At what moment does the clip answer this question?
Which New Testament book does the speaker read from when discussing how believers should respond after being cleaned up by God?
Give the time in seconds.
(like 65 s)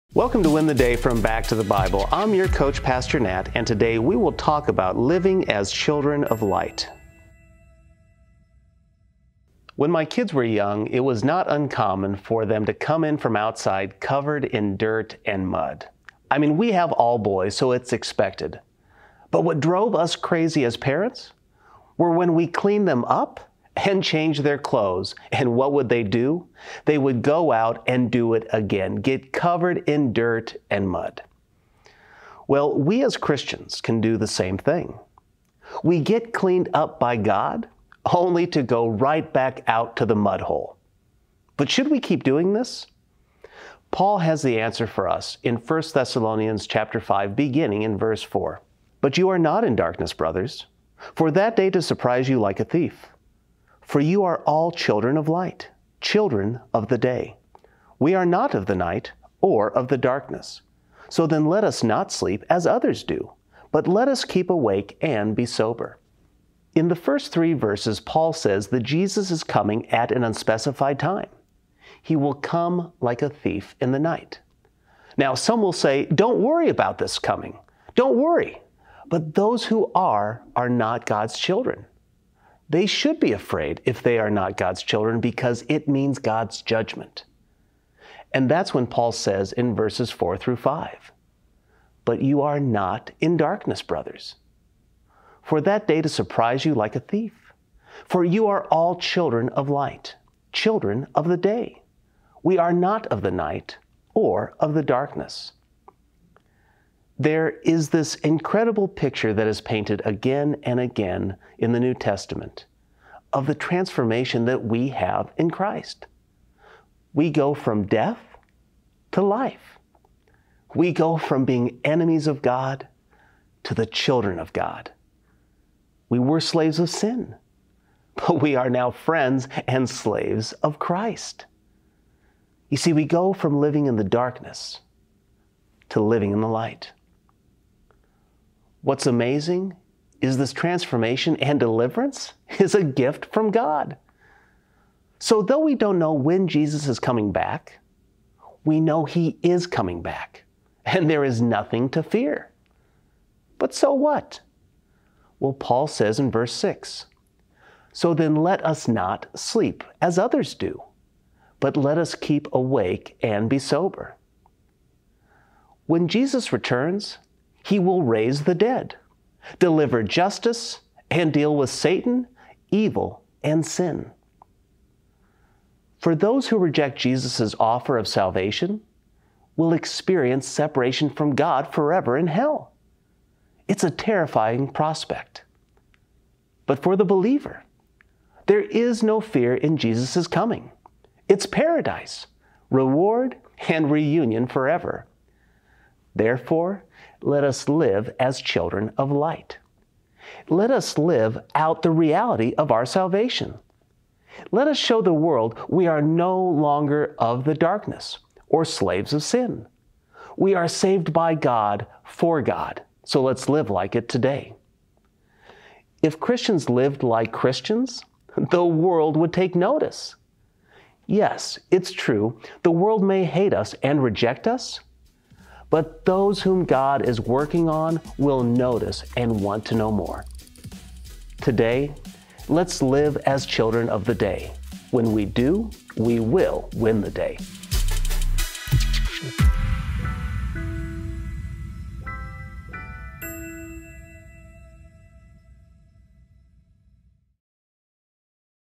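45 s.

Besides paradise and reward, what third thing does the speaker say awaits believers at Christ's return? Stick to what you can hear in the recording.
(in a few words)
reunion.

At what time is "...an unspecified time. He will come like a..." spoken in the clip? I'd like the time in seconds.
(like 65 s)
70 s.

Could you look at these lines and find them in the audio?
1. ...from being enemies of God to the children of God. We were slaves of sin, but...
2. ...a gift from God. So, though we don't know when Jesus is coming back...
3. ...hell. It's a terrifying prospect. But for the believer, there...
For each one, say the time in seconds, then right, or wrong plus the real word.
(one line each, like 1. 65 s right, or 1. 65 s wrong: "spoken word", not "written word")
1. 121 s right
2. 142 s right
3. 182 s right.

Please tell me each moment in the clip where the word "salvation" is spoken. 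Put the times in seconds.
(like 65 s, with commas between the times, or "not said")
178 s, 202 s.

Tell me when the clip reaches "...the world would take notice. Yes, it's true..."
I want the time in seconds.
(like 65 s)
218 s.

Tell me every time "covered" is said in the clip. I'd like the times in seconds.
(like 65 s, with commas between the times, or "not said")
13 s, 29 s.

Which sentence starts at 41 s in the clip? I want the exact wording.
But should we keep doing this?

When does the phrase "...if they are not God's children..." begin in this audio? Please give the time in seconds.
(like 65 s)
83 s.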